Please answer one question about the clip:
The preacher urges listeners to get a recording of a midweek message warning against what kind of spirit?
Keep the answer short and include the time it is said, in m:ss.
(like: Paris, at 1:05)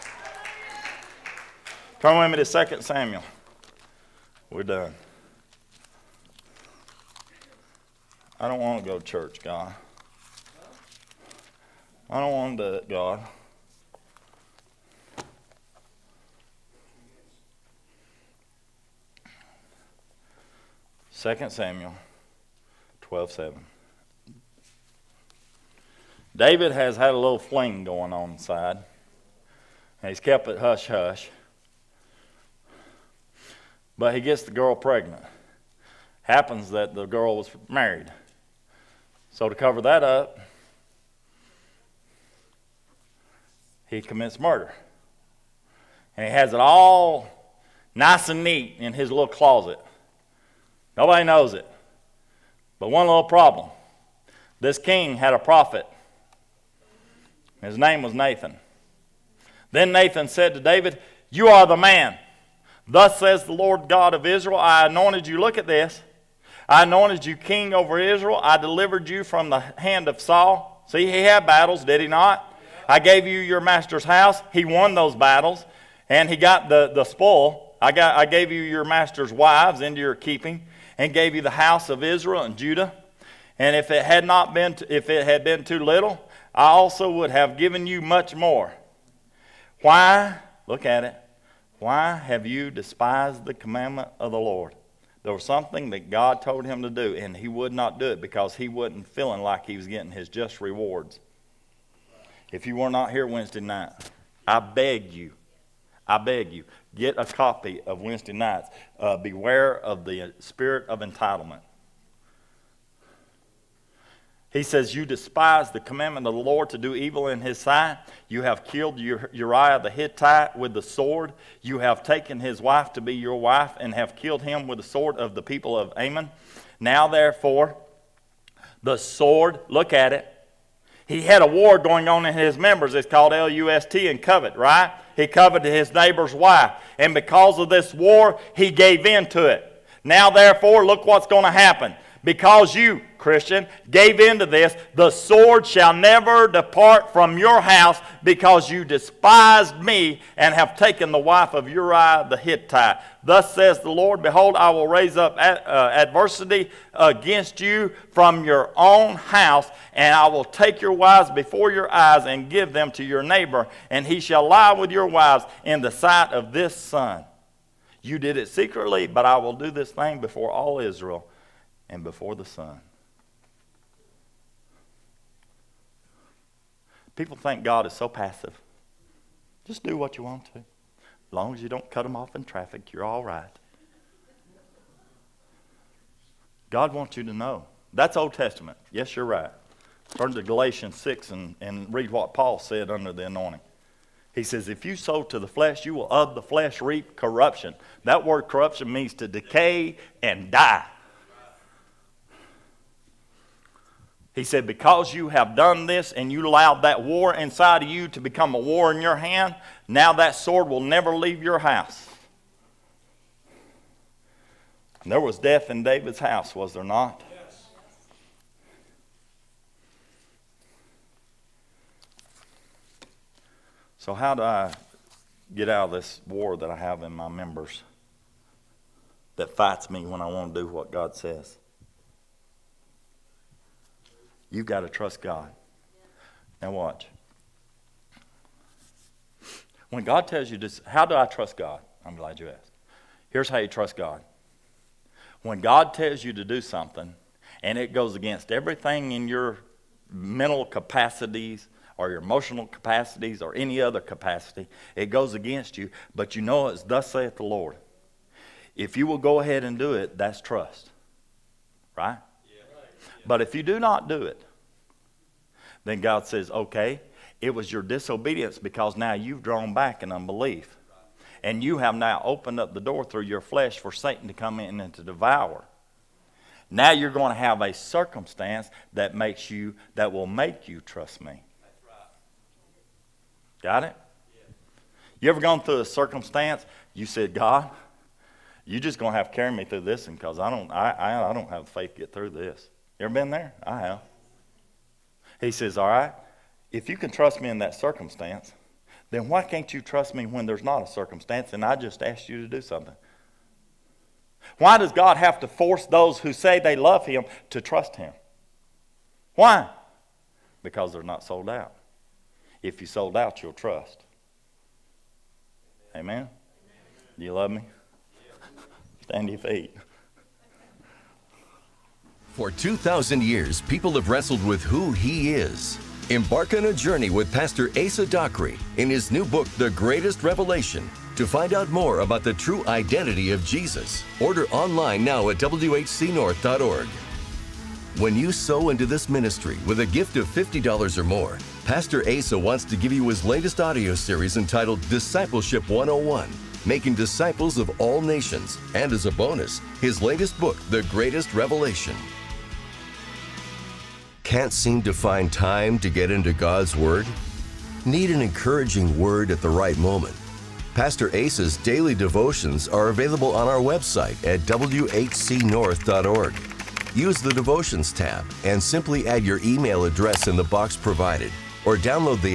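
Entitlement, at 1:51.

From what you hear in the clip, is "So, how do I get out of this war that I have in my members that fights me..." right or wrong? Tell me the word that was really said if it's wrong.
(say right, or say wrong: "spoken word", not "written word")
right.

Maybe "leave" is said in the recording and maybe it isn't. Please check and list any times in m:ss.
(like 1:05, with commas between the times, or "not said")
3:31.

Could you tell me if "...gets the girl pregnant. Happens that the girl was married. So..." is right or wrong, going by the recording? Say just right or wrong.
right.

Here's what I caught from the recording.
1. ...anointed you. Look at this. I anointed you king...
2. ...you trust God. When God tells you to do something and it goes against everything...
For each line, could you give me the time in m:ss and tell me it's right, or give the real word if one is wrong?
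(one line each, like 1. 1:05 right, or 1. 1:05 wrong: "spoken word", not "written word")
1. 1:04 right
2. 4:03 right.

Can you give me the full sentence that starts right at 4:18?
If you will go ahead and do it, that's trust.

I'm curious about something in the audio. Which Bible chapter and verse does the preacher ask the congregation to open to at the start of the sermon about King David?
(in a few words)
2 Samuel 12:7.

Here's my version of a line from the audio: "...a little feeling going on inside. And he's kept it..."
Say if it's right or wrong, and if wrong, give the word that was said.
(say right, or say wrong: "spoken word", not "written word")
wrong: "fling", not "feeling".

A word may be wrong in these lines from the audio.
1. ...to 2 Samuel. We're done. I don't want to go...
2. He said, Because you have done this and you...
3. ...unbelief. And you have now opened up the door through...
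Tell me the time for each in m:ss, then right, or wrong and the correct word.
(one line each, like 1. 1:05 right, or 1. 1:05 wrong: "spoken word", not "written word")
1. 0:02 right
2. 3:24 right
3. 4:30 right.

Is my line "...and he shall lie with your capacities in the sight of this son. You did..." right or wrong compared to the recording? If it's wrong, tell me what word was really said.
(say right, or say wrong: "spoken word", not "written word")
wrong: "wives", not "capacities".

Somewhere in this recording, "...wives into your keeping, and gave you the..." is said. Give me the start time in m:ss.
1:19.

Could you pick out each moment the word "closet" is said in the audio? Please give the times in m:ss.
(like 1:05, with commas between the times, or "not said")
0:49.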